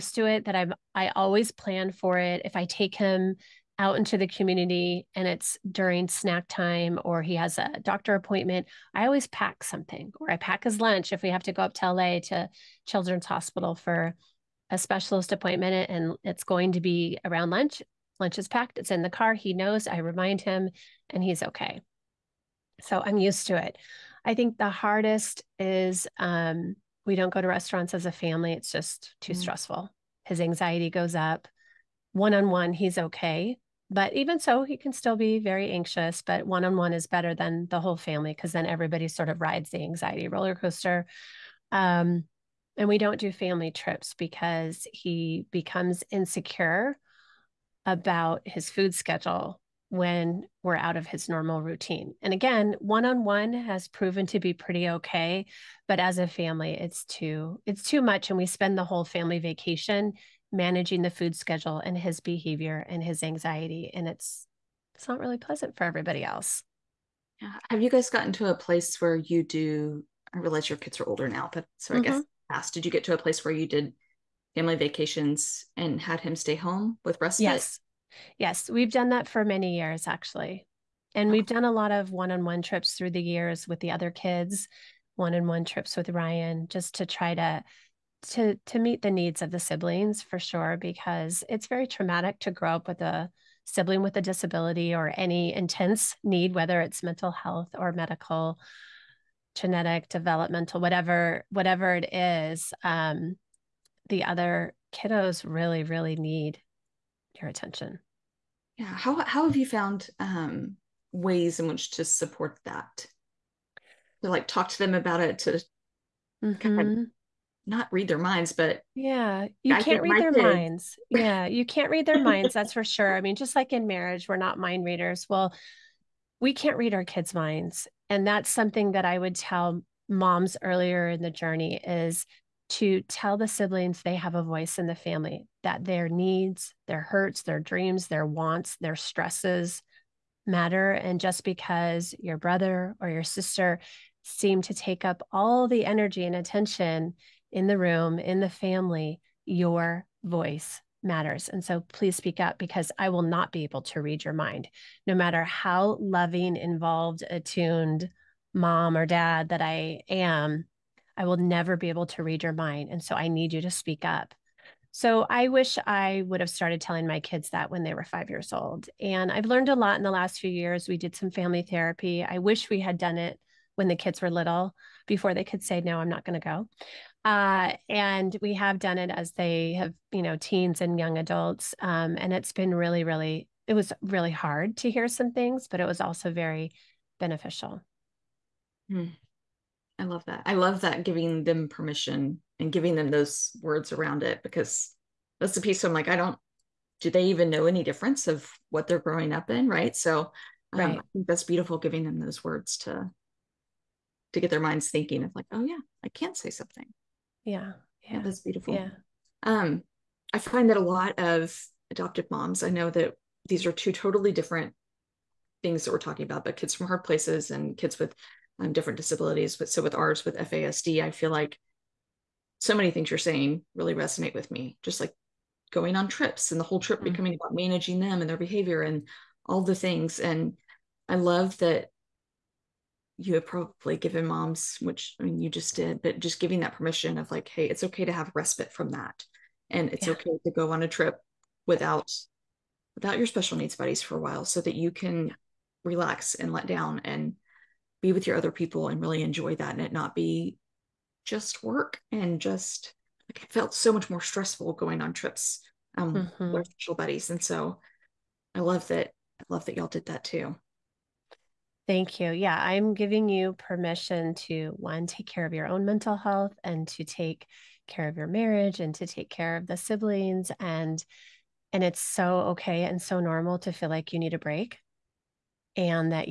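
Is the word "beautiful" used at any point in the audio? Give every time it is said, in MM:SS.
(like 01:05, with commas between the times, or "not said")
03:21, 03:28.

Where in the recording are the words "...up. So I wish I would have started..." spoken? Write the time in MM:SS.
02:44.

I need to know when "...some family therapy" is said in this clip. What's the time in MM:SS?
02:51.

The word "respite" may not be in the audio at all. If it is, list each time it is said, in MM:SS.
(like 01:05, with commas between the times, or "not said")
01:17, 03:58.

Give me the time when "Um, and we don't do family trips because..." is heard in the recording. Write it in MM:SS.
00:41.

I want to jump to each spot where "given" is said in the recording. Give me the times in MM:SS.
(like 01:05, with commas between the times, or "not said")
03:53.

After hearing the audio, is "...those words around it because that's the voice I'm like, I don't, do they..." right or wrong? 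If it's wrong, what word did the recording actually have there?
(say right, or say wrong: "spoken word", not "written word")
wrong: "piece", not "voice".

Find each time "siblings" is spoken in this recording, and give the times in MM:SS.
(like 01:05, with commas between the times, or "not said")
01:29, 01:33, 02:13, 04:29.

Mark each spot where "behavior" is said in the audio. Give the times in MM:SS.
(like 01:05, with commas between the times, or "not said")
01:02, 03:48.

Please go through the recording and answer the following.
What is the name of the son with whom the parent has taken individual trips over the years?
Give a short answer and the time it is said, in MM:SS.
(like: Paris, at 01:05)
Ryan, at 01:26.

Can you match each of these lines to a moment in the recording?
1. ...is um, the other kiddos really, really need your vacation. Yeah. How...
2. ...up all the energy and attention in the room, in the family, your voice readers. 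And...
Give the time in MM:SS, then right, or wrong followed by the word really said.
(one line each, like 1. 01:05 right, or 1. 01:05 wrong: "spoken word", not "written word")
1. 01:42 wrong: "attention", not "vacation"
2. 02:25 wrong: "matters", not "readers".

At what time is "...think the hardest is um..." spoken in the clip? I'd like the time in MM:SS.
00:24.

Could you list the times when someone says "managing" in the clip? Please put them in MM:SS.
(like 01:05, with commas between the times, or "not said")
01:00, 03:47.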